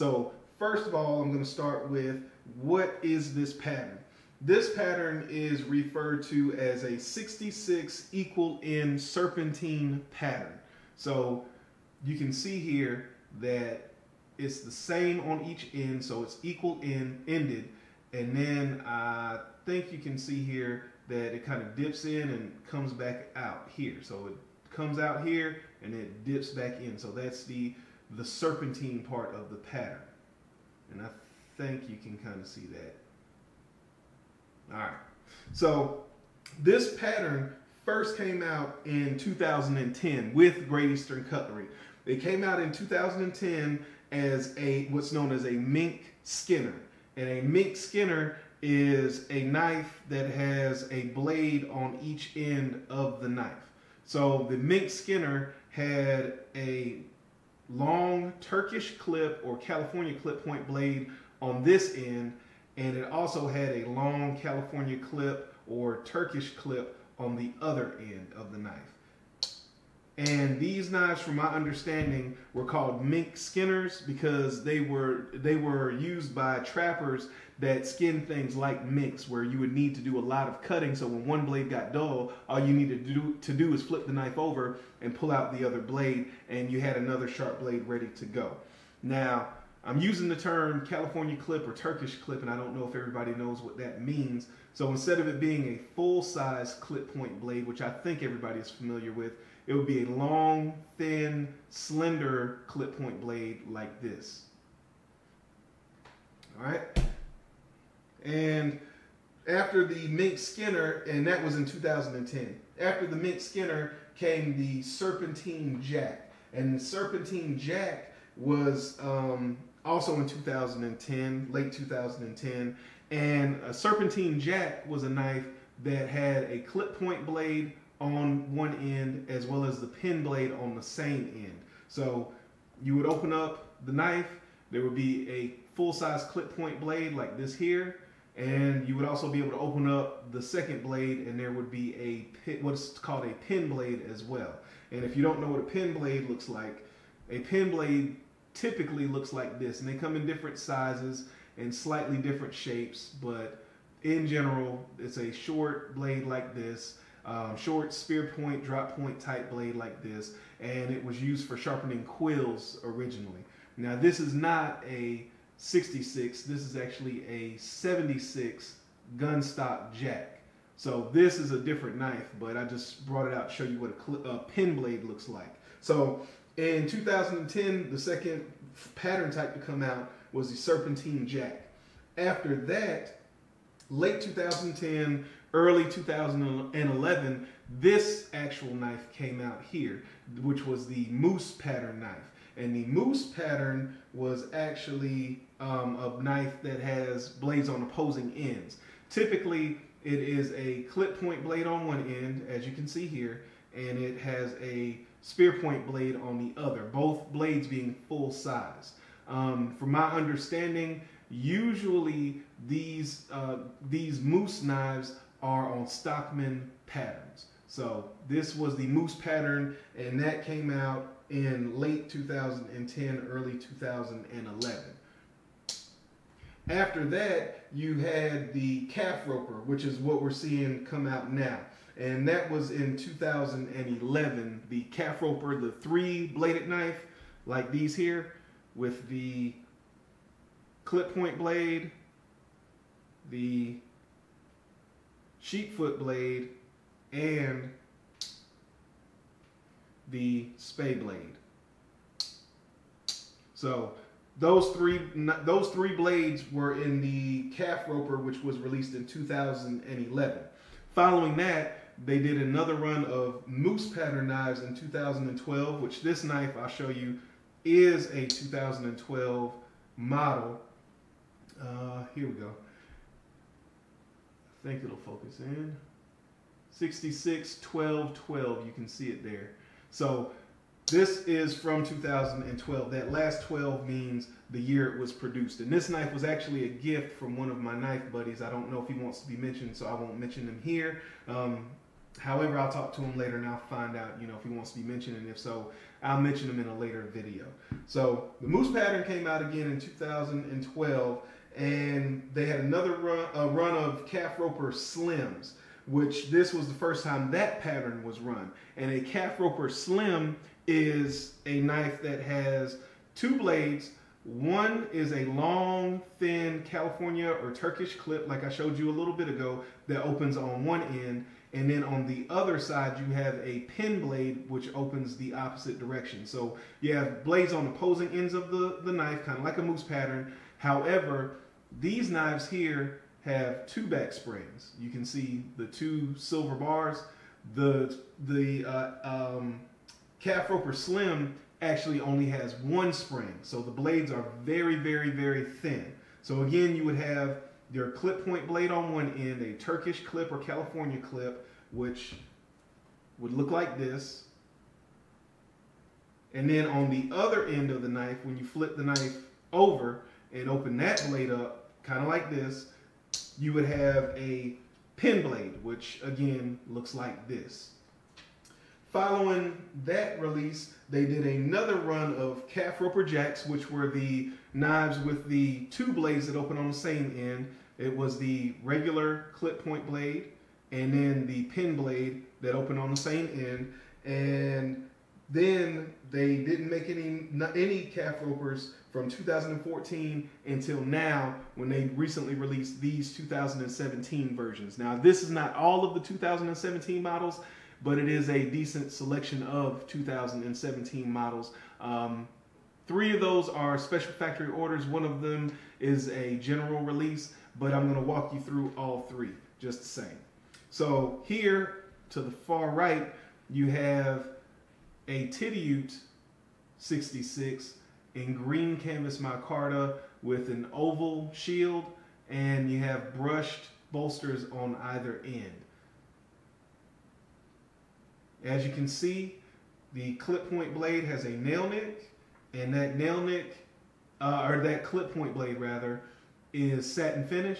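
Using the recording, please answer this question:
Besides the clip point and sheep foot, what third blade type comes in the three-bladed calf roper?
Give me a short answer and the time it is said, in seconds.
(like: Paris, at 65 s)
Spay blade, at 250 s.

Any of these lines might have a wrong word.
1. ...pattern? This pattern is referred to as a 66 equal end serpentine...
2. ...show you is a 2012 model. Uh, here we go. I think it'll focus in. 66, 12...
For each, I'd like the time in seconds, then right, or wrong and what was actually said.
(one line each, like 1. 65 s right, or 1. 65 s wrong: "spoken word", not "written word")
1. 3 s right
2. 266 s right.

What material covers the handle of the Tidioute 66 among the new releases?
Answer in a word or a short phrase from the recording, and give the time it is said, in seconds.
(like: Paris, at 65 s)
Green canvas micarta, at 418 s.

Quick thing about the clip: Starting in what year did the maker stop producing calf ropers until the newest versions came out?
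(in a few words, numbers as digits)
2014.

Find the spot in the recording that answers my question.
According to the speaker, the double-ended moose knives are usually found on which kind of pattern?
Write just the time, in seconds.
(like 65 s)
215 s.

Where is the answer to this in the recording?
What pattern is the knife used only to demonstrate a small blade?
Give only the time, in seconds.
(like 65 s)
167 s.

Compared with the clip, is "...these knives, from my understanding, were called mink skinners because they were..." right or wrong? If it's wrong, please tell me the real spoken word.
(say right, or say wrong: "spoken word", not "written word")
right.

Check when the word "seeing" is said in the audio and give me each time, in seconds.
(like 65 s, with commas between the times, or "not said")
230 s.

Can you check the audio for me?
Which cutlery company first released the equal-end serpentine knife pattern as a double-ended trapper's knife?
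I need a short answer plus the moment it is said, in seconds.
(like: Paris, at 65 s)
Great Eastern Cutlery, at 40 s.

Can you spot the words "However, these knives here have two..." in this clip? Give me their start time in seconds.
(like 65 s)
330 s.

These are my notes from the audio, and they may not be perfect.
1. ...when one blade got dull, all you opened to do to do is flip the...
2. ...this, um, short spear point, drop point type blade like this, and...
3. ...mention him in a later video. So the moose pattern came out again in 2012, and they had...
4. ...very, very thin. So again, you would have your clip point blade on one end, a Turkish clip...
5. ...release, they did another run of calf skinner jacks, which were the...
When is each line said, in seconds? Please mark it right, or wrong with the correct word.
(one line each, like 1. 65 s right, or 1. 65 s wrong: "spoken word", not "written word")
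1. 81 s wrong: "needed", not "opened"
2. 156 s right
3. 296 s right
4. 344 s right
5. 370 s wrong: "roper", not "skinner".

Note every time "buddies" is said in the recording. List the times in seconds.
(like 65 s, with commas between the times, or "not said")
288 s.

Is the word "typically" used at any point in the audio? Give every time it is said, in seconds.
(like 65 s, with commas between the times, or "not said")
148 s, 199 s.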